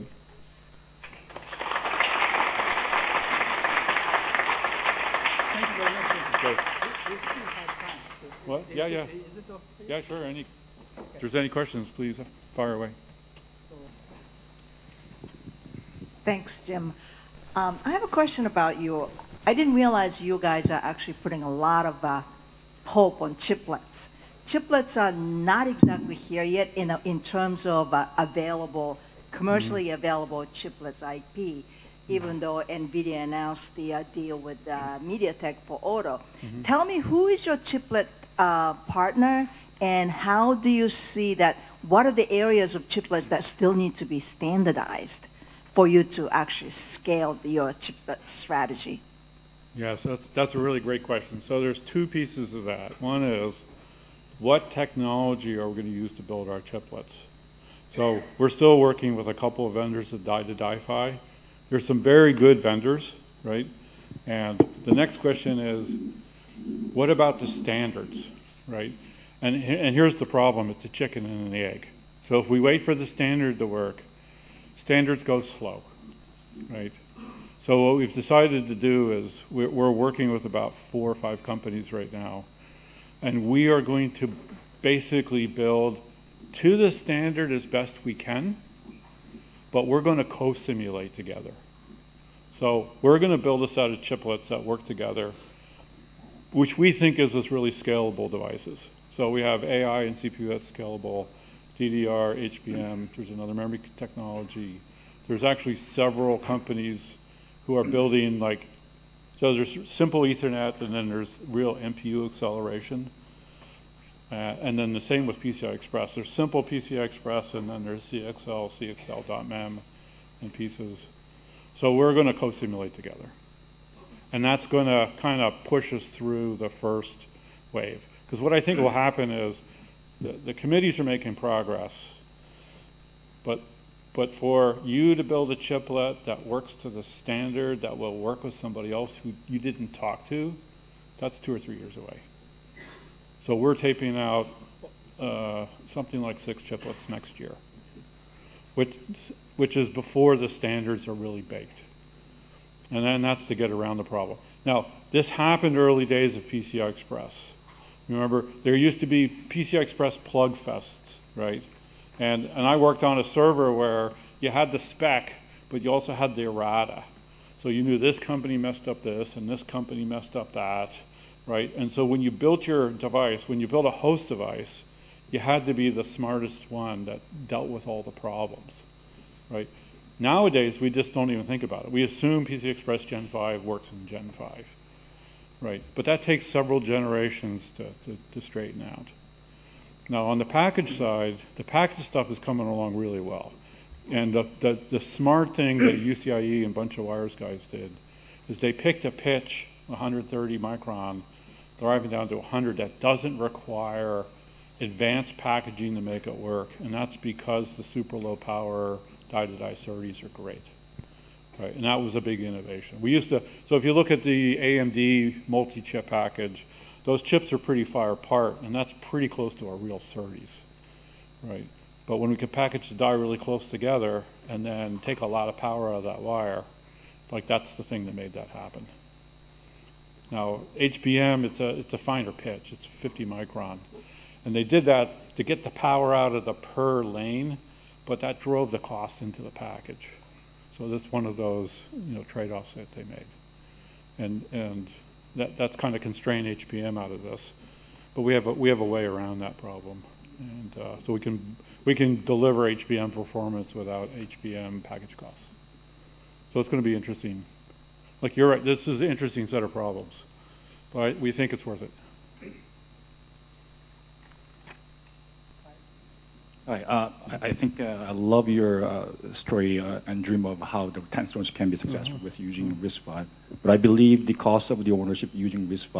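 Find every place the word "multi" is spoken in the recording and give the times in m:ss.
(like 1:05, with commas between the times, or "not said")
3:35.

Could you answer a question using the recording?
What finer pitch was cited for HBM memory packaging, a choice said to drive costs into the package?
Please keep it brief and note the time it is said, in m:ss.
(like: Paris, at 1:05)
50 micron, at 3:52.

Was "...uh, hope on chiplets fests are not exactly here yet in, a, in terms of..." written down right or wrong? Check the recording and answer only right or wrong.
wrong.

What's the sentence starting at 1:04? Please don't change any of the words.
And the next question is, what about the standards, right?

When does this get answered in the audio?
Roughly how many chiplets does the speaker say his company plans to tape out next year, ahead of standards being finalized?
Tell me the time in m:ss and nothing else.
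2:26.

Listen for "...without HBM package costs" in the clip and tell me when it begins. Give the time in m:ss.
4:13.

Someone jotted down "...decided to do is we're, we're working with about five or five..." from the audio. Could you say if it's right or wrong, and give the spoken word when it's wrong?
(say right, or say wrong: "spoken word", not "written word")
wrong: "four", not "five".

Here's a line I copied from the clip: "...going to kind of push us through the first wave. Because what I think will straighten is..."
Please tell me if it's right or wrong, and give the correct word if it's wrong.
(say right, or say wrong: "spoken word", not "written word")
wrong: "happen", not "straighten".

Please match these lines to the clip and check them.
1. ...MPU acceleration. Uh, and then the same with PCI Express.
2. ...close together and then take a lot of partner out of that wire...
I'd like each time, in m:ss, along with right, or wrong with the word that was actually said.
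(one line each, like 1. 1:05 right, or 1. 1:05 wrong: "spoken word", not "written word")
1. 1:51 right
2. 3:43 wrong: "power", not "partner".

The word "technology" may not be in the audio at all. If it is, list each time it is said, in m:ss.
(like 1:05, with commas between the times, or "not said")
0:54, 1:43.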